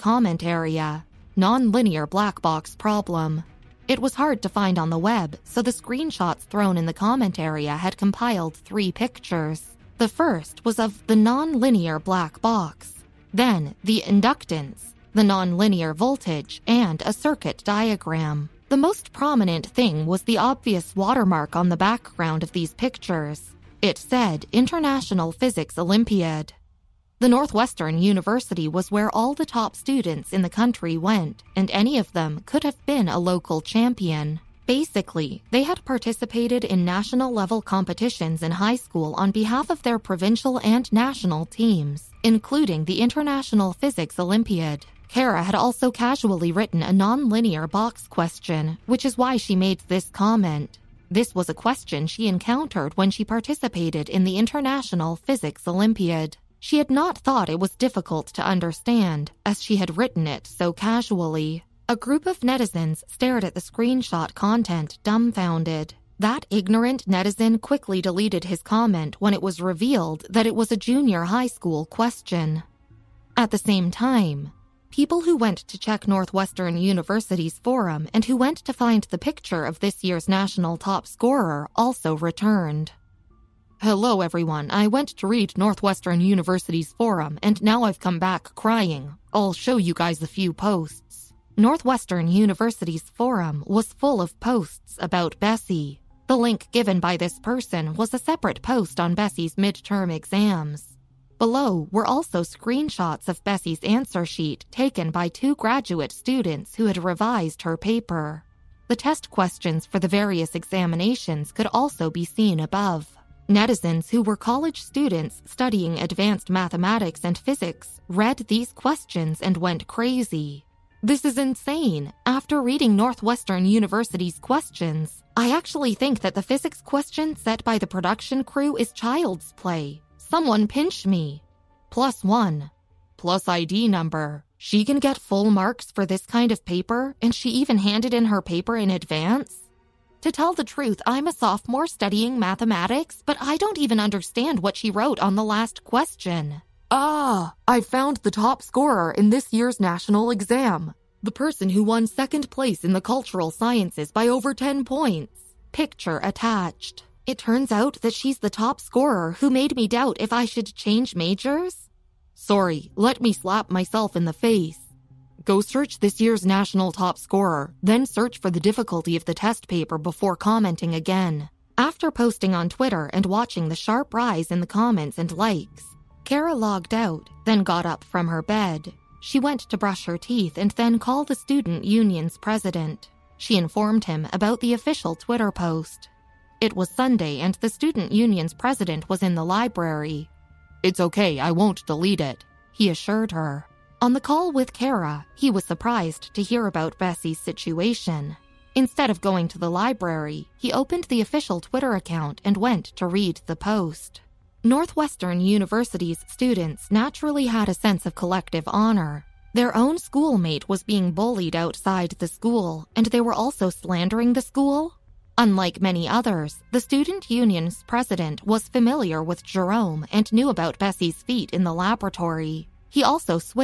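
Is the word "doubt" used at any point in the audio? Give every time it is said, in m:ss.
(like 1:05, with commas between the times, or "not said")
2:39.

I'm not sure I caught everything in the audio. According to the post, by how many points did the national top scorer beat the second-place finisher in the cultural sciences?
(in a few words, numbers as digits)
10.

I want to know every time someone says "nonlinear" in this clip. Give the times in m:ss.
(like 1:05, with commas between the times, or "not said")
0:01, 0:11, 0:15.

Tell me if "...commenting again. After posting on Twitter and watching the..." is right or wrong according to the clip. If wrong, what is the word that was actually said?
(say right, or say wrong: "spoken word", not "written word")
right.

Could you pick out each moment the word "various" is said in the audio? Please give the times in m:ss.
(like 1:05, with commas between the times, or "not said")
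1:50.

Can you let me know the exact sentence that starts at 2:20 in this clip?
To tell the truth, I'm a sophomore studying mathematics, but I don't even understand what she wrote on the last question.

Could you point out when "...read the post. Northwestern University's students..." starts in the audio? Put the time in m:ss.
3:23.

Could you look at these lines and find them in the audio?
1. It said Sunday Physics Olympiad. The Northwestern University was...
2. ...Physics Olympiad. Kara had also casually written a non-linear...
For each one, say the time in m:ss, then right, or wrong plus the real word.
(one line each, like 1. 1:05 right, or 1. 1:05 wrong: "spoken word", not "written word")
1. 0:23 wrong: "International", not "Sunday"
2. 0:43 right.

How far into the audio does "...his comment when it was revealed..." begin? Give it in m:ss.
1:08.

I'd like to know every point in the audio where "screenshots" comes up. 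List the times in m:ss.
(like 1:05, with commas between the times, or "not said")
0:05, 1:03, 1:42.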